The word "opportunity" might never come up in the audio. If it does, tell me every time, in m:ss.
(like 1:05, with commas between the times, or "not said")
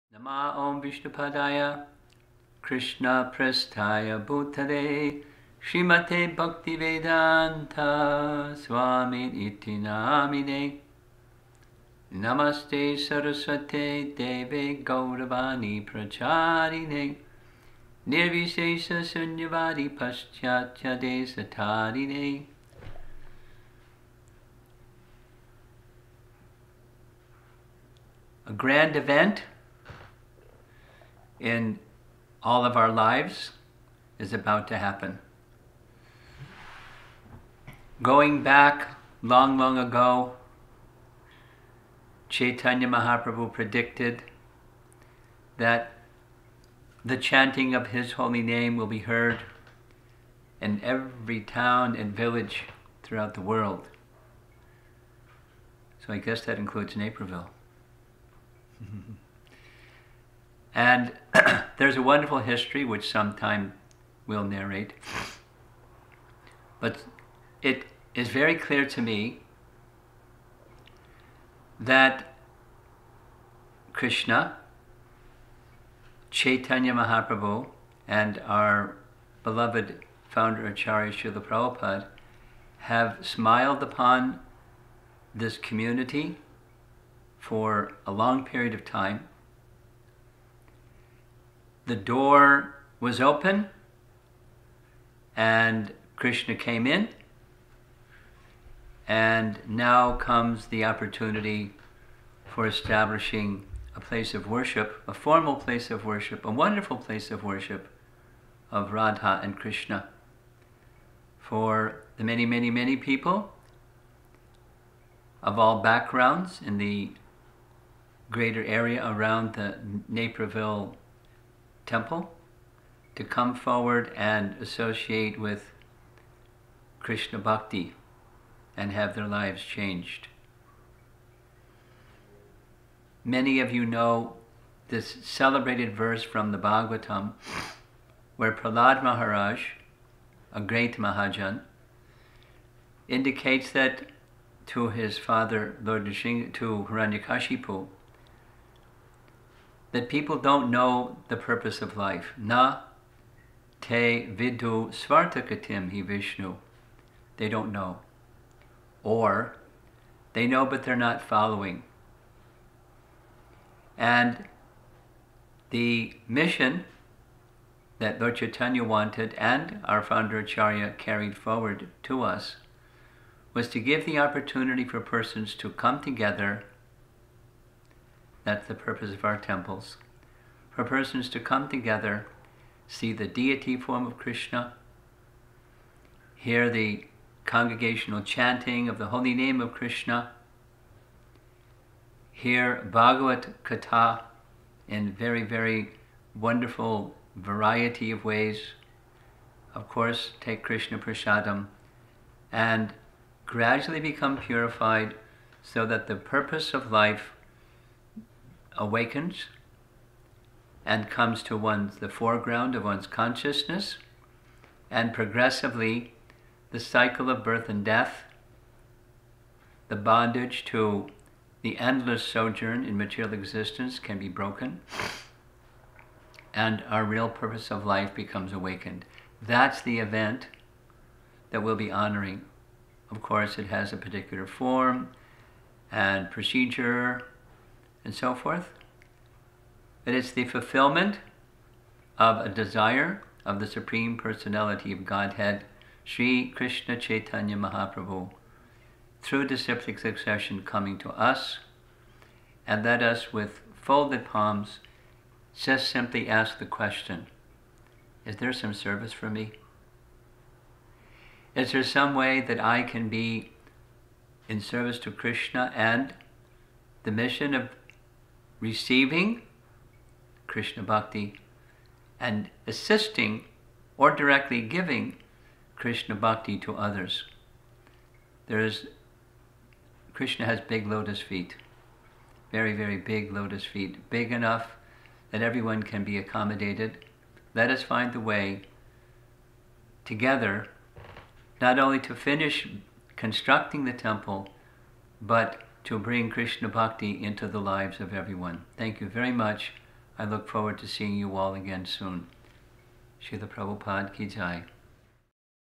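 1:40, 2:54.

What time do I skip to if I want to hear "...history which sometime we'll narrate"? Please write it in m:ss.
1:02.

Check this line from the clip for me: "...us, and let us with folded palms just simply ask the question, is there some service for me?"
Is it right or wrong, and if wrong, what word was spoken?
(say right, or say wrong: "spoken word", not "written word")
right.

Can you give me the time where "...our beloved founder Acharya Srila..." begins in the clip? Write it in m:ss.
1:18.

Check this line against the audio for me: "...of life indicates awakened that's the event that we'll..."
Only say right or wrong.
wrong.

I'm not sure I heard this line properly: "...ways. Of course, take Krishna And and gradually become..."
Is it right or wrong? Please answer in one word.
wrong.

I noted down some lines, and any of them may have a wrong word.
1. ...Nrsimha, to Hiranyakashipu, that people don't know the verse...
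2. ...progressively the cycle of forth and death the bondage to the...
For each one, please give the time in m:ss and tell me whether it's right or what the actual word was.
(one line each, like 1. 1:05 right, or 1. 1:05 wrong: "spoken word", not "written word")
1. 2:26 wrong: "purpose", not "verse"
2. 3:35 wrong: "birth", not "forth".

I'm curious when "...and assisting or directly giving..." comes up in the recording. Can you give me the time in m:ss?
4:32.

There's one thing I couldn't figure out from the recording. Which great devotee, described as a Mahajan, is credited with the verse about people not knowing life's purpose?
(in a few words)
Prahlad Maharaj.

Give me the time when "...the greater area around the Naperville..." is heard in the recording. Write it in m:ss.
1:56.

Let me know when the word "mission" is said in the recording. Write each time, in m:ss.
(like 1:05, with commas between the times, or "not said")
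2:46, 4:27.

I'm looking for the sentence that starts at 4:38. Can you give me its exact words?
There is, Krishna has big lotus feet, very, very big lotus feet, big enough that everyone can be accommodated.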